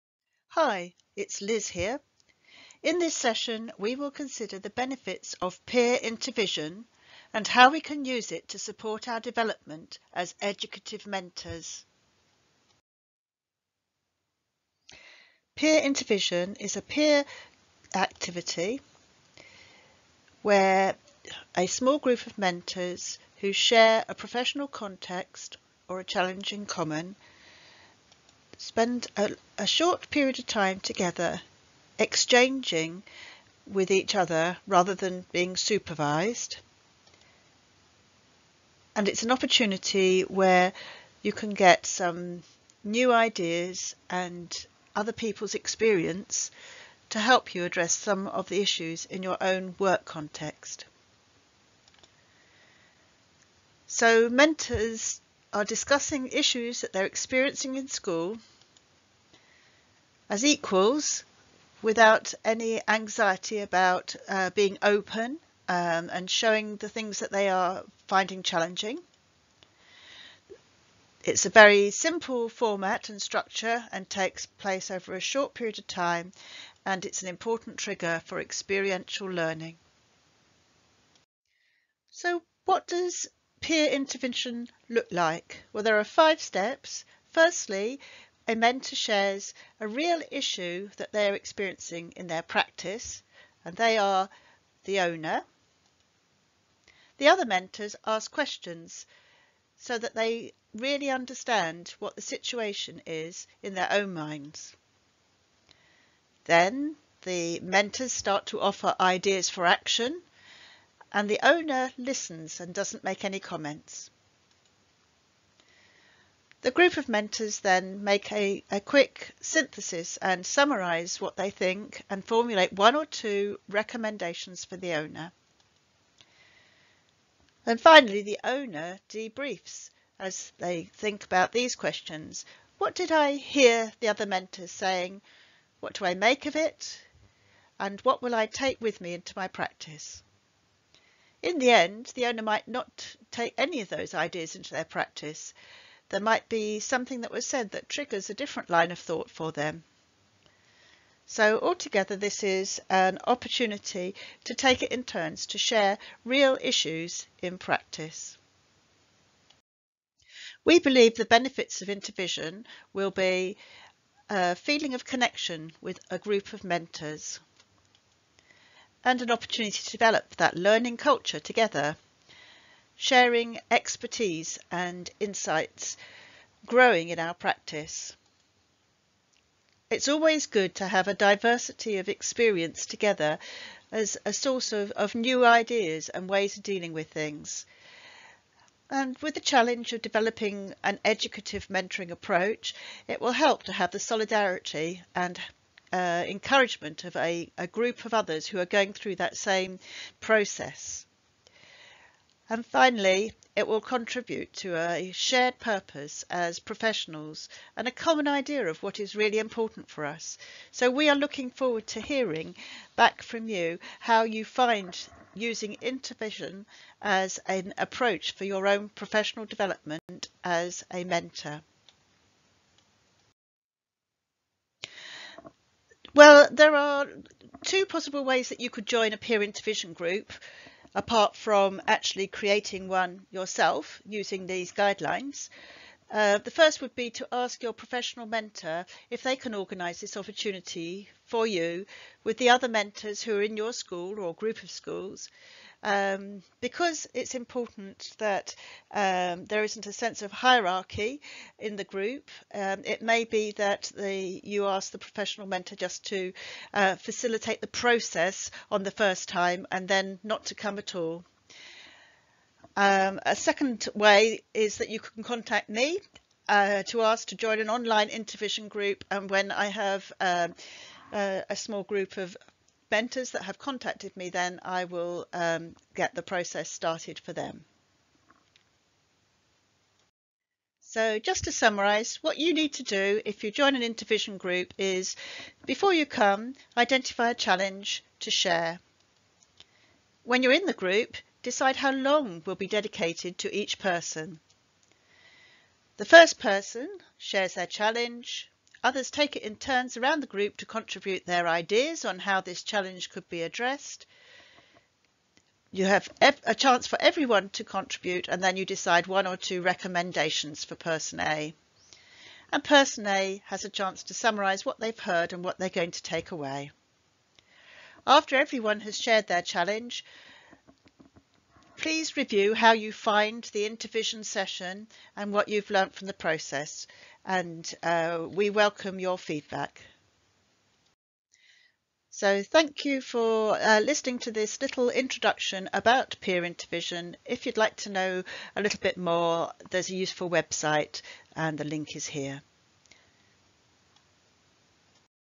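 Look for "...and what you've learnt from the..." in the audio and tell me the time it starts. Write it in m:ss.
5:25.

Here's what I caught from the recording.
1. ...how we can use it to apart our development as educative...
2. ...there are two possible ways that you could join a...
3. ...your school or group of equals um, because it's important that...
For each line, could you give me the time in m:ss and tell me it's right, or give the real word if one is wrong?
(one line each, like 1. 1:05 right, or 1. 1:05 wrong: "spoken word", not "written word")
1. 0:07 wrong: "support", not "apart"
2. 3:46 right
3. 4:03 wrong: "schools", not "equals".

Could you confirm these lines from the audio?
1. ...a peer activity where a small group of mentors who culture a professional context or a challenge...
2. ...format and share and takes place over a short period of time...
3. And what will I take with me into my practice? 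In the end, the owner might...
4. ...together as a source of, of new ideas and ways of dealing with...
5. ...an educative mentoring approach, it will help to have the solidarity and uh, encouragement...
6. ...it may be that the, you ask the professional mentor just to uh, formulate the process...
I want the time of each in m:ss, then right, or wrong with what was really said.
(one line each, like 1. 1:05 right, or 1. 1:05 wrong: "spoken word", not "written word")
1. 0:16 wrong: "share", not "culture"
2. 1:12 wrong: "structure", not "share"
3. 2:17 right
4. 3:02 right
5. 3:10 right
6. 4:12 wrong: "facilitate", not "formulate".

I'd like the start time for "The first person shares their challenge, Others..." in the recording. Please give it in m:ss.
4:55.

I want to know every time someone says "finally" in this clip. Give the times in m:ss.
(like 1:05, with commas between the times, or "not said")
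2:07, 3:22.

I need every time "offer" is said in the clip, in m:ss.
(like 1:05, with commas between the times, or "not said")
1:48.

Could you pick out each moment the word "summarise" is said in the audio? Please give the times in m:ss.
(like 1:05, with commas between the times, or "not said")
2:00, 4:41, 5:14.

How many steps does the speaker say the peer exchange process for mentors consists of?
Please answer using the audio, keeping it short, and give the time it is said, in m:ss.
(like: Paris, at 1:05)
5, at 1:26.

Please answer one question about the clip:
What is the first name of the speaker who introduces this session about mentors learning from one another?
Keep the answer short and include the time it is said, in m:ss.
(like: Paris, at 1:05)
Liz, at 0:01.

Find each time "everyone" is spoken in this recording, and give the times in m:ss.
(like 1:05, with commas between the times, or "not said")
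5:07, 5:18.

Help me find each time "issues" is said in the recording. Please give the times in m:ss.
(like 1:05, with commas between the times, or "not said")
0:48, 0:56, 1:30, 2:36.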